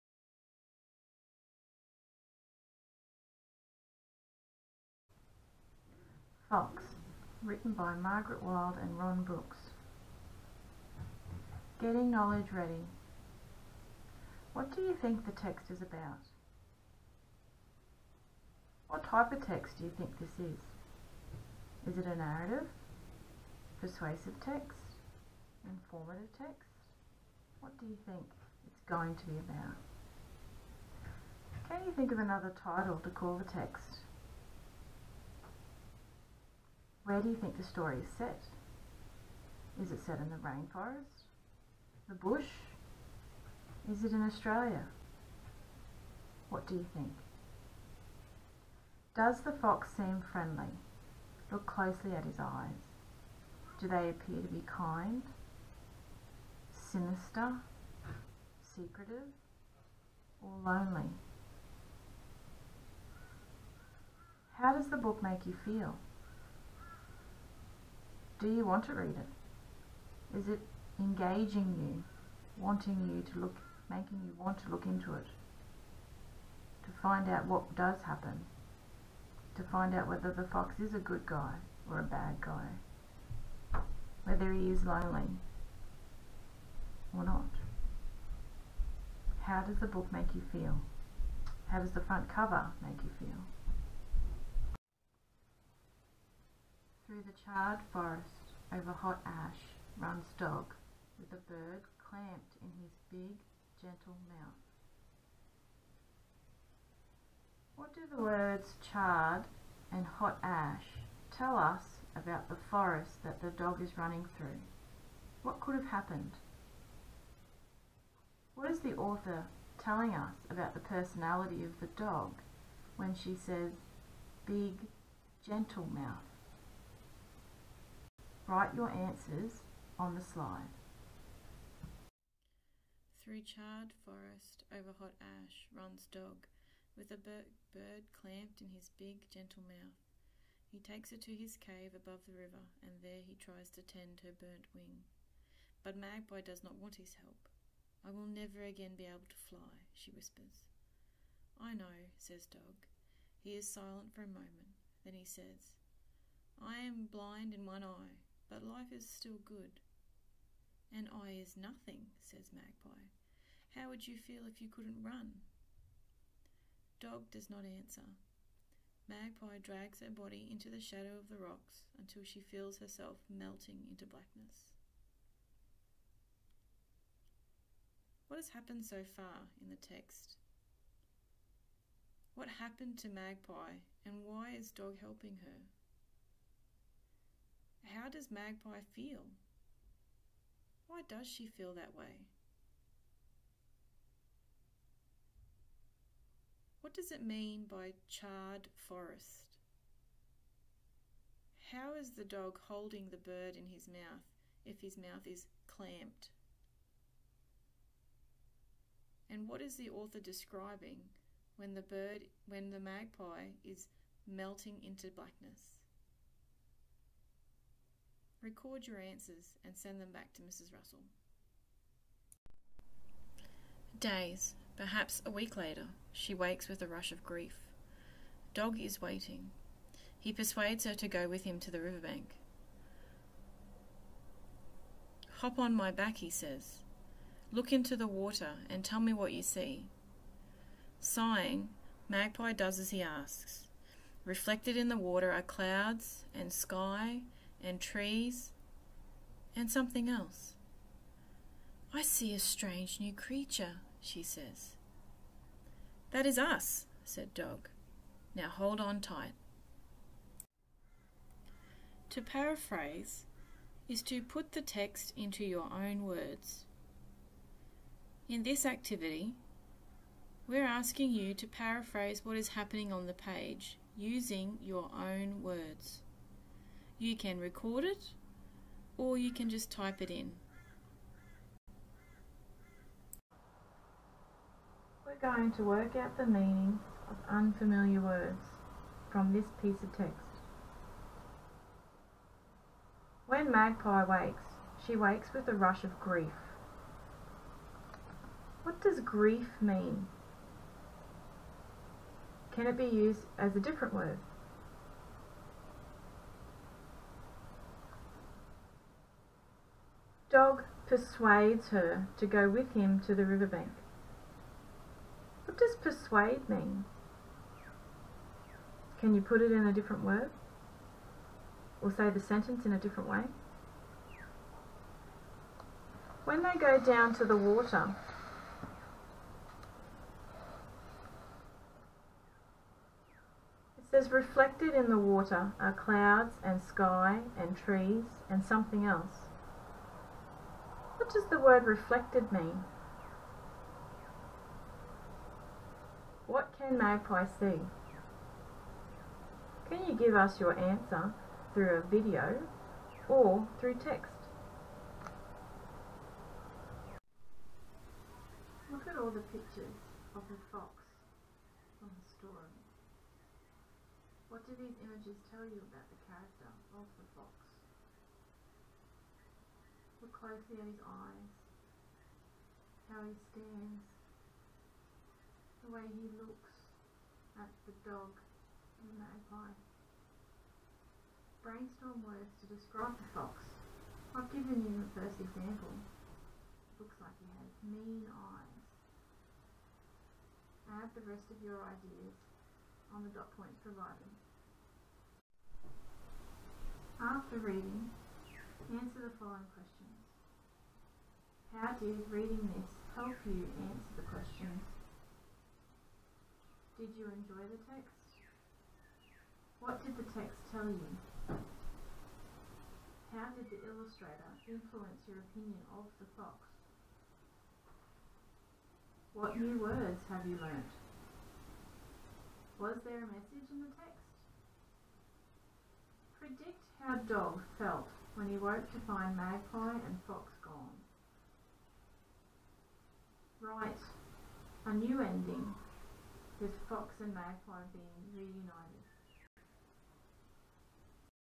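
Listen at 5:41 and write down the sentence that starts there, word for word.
What does the word reflected mean?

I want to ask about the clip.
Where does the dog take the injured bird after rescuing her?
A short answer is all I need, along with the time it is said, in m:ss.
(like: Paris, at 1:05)
His cave above the river, at 2:21.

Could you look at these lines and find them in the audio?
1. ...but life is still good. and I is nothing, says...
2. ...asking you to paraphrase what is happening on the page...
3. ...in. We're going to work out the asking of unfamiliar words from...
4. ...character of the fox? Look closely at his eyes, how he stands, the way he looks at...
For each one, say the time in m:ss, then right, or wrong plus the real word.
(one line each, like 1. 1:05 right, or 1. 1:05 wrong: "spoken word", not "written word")
1. 2:38 right
2. 4:30 right
3. 4:40 wrong: "meaning", not "asking"
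4. 6:06 right.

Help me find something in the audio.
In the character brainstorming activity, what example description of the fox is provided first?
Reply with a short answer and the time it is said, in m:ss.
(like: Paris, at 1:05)
Mean eyes, at 6:27.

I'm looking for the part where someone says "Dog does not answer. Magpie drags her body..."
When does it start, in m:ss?
2:46.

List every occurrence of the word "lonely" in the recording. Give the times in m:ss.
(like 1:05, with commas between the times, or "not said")
1:00, 1:24.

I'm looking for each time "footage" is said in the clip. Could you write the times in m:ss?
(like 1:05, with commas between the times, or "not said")
not said.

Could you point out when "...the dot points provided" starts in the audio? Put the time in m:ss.
6:33.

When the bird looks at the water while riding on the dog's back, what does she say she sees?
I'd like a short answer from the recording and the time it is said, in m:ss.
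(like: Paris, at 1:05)
A strange new creature, at 4:12.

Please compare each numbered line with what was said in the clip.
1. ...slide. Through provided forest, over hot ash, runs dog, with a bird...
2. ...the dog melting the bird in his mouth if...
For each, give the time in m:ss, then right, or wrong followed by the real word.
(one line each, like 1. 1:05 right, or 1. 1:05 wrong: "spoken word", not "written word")
1. 2:10 wrong: "charred", not "provided"
2. 3:22 wrong: "holding", not "melting".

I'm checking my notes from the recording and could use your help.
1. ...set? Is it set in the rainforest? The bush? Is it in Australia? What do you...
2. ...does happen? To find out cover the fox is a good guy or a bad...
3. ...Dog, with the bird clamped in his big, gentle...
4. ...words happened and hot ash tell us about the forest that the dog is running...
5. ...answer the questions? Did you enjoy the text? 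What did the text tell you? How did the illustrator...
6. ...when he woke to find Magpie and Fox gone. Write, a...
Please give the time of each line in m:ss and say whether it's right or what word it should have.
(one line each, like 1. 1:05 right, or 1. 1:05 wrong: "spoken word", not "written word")
1. 0:38 right
2. 1:17 wrong: "whether", not "cover"
3. 1:40 right
4. 1:48 wrong: "charred", not "happened"
5. 6:43 right
6. 7:08 right.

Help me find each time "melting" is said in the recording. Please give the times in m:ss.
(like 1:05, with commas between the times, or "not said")
2:53, 3:34.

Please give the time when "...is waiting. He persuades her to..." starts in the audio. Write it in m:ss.
3:48.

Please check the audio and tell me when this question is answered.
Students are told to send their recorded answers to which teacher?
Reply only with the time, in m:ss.
3:40.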